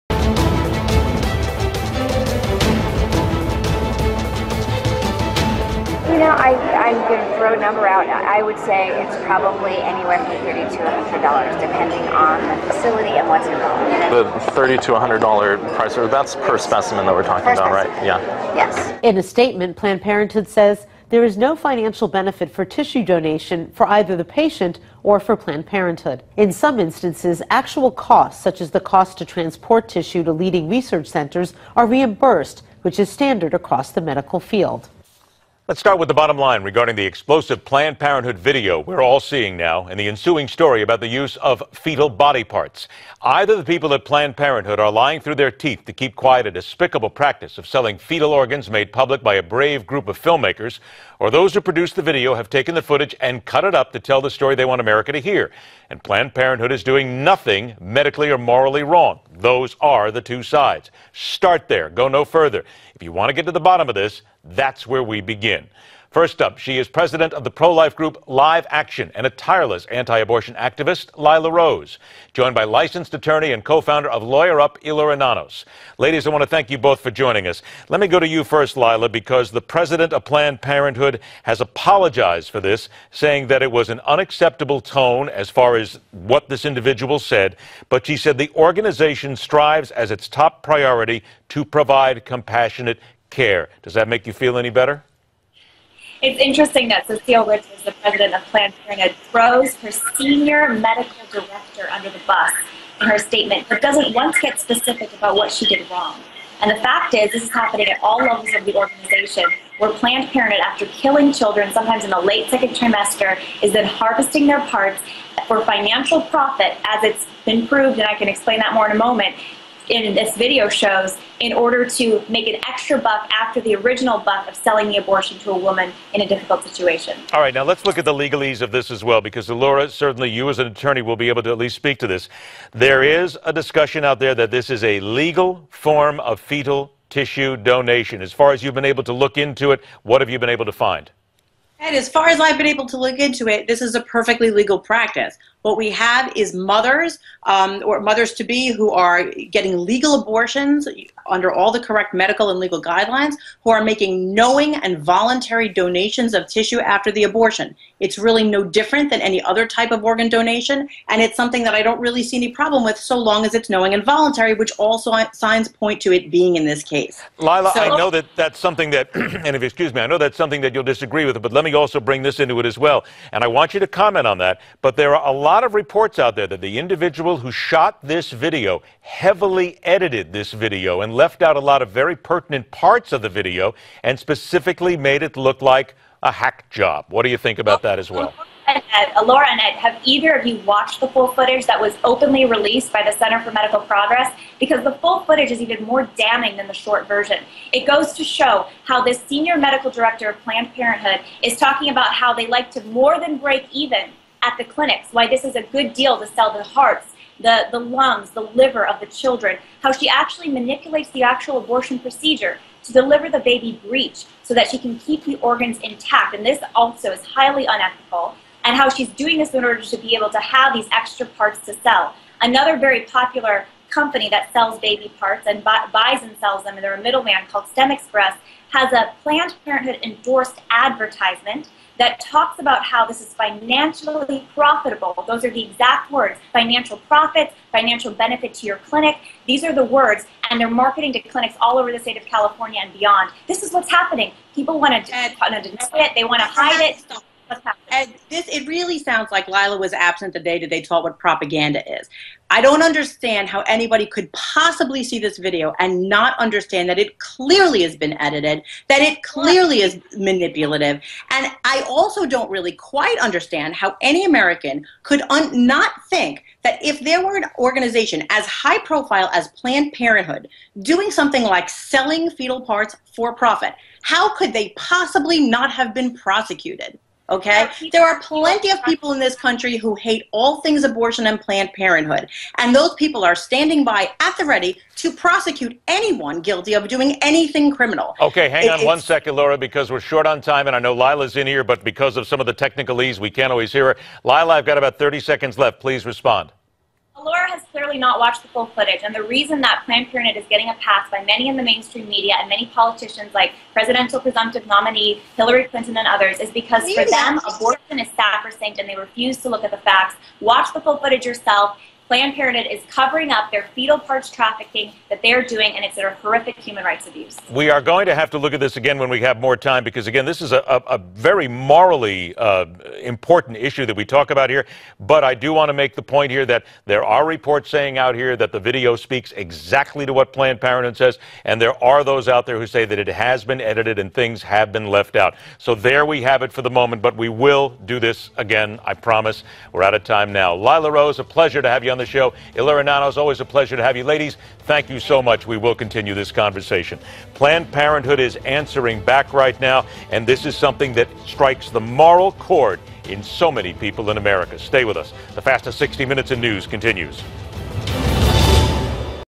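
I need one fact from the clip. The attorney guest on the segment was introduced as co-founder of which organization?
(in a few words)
Lawyer Up.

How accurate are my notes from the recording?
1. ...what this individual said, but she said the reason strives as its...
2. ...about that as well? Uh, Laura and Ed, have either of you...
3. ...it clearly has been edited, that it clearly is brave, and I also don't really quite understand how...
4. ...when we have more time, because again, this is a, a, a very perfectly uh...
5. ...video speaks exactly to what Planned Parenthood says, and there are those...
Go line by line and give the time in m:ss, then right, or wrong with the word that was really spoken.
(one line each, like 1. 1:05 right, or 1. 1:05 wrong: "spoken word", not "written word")
1. 1:26 wrong: "organization", not "reason"
2. 3:07 right
3. 4:16 wrong: "manipulative", not "brave"
4. 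5:18 wrong: "morally", not "perfectly"
5. 5:28 right.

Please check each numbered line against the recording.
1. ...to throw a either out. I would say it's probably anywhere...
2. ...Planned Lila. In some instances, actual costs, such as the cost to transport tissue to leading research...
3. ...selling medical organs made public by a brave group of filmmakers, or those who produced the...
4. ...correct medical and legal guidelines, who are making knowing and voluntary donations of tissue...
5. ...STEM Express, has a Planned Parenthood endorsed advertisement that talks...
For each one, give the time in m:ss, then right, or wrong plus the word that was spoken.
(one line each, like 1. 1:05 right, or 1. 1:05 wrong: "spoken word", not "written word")
1. 0:07 wrong: "number", not "either"
2. 0:25 wrong: "Parenthood", not "Lila"
3. 0:47 wrong: "fetal", not "medical"
4. 2:31 right
5. 3:47 right.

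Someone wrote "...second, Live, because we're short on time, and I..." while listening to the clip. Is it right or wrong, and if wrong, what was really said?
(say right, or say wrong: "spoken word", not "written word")
wrong: "Laura", not "Live".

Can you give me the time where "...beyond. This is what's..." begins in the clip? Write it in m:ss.
4:02.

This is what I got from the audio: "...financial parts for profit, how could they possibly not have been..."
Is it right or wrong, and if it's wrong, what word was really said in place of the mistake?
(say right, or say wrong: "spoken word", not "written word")
wrong: "fetal", not "financial".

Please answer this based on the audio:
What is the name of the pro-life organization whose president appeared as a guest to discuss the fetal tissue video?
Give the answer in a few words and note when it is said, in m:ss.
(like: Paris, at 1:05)
Live Action, at 1:08.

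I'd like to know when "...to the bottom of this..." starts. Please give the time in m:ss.
1:03.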